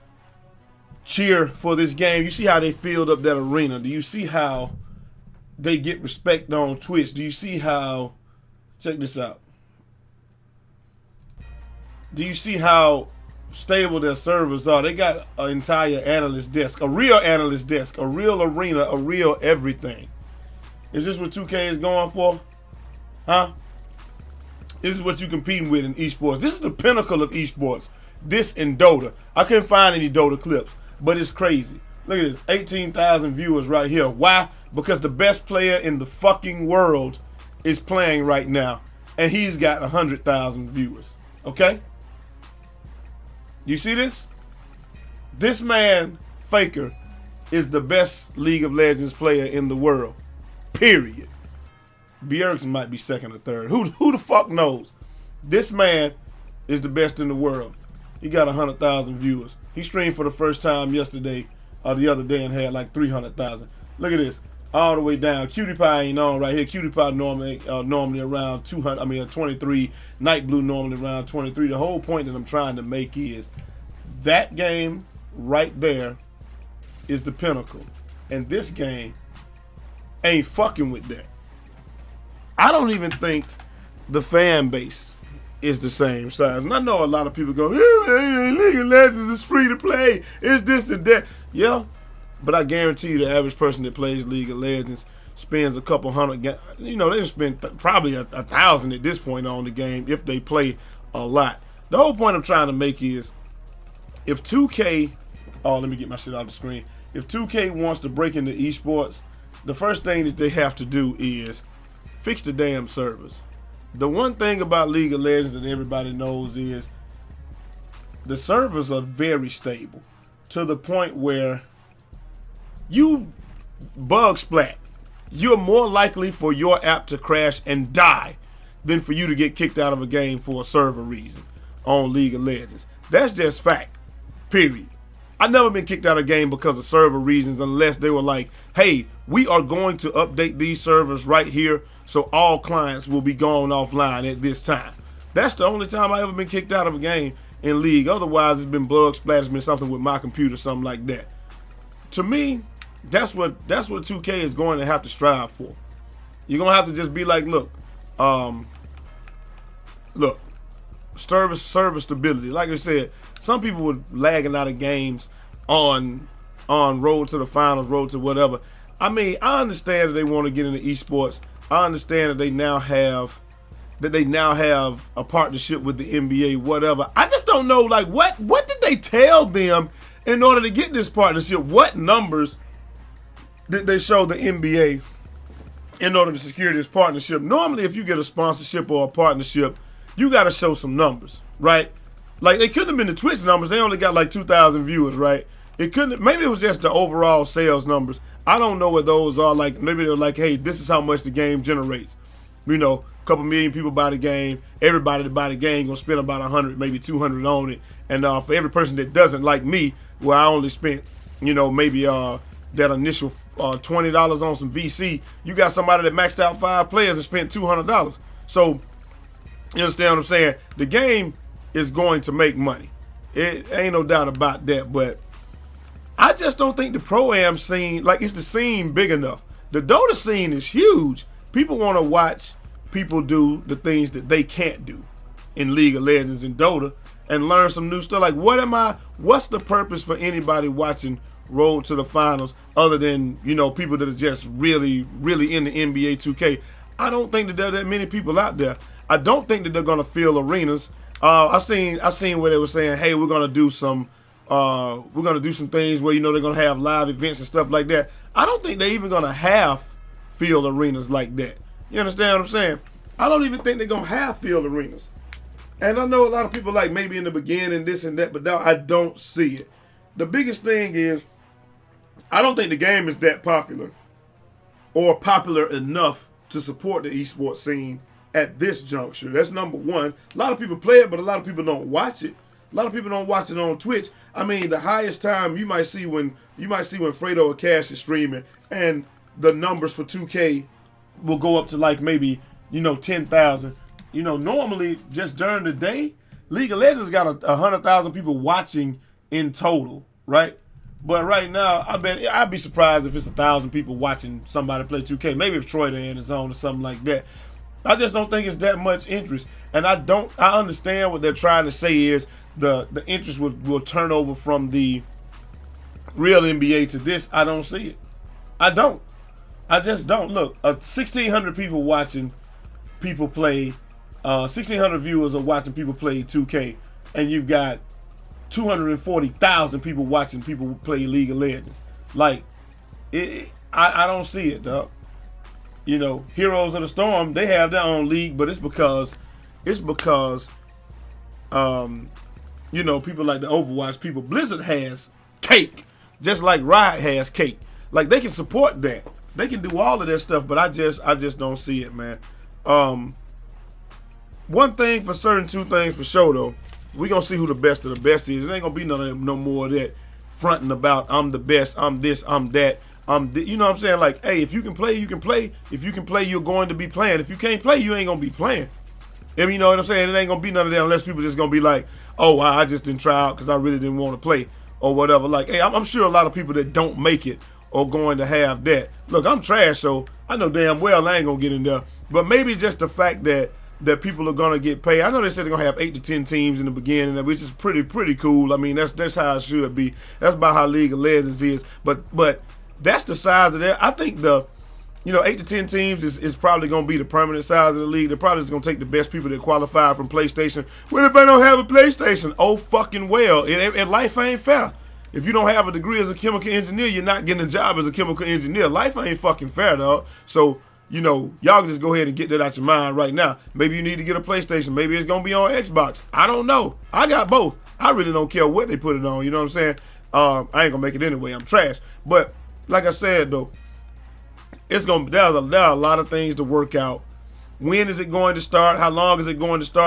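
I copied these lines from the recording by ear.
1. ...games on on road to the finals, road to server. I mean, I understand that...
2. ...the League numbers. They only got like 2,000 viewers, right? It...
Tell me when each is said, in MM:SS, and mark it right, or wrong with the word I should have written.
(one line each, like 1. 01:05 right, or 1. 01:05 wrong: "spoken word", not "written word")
1. 02:44 wrong: "whatever", not "server"
2. 03:13 wrong: "Twitch", not "League".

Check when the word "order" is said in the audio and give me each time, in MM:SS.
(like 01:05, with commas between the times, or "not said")
03:00, 03:06.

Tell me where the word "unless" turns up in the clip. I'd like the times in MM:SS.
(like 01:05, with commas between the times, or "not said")
02:17, 06:10.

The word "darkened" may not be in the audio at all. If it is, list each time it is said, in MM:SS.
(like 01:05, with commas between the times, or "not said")
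not said.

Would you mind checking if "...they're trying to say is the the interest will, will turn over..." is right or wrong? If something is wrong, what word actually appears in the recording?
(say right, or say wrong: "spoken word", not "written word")
right.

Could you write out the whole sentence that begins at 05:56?
We're gonna see who the best of the best is.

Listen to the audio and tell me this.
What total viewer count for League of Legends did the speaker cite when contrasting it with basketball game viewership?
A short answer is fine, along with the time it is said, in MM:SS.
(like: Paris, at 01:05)
240,000, at 05:28.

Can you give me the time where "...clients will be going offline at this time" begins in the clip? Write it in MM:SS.
02:22.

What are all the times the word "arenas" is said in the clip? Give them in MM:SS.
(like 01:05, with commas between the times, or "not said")
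00:03, 00:18, 04:10, 04:20, 04:24.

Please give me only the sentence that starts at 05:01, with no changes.
But right now, I bet I'd be surprised if it's a thousand people watching somebody play 2K.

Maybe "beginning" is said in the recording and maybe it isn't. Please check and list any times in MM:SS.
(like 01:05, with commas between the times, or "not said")
04:27, 06:26.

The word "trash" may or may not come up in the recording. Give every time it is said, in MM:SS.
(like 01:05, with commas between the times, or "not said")
06:19, 07:01.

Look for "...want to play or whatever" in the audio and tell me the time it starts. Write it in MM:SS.
06:13.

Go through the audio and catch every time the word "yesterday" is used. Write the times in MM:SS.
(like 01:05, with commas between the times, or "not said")
01:00.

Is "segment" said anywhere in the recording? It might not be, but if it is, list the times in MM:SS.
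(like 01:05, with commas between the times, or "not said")
not said.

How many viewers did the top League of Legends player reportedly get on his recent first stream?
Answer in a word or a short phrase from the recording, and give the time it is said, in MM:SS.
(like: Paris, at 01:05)
300,000, at 01:02.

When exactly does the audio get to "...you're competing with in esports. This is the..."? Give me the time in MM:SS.
00:25.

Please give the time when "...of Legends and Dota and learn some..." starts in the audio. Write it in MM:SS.
03:55.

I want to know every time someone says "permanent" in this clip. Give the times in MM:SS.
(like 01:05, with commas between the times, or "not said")
06:37.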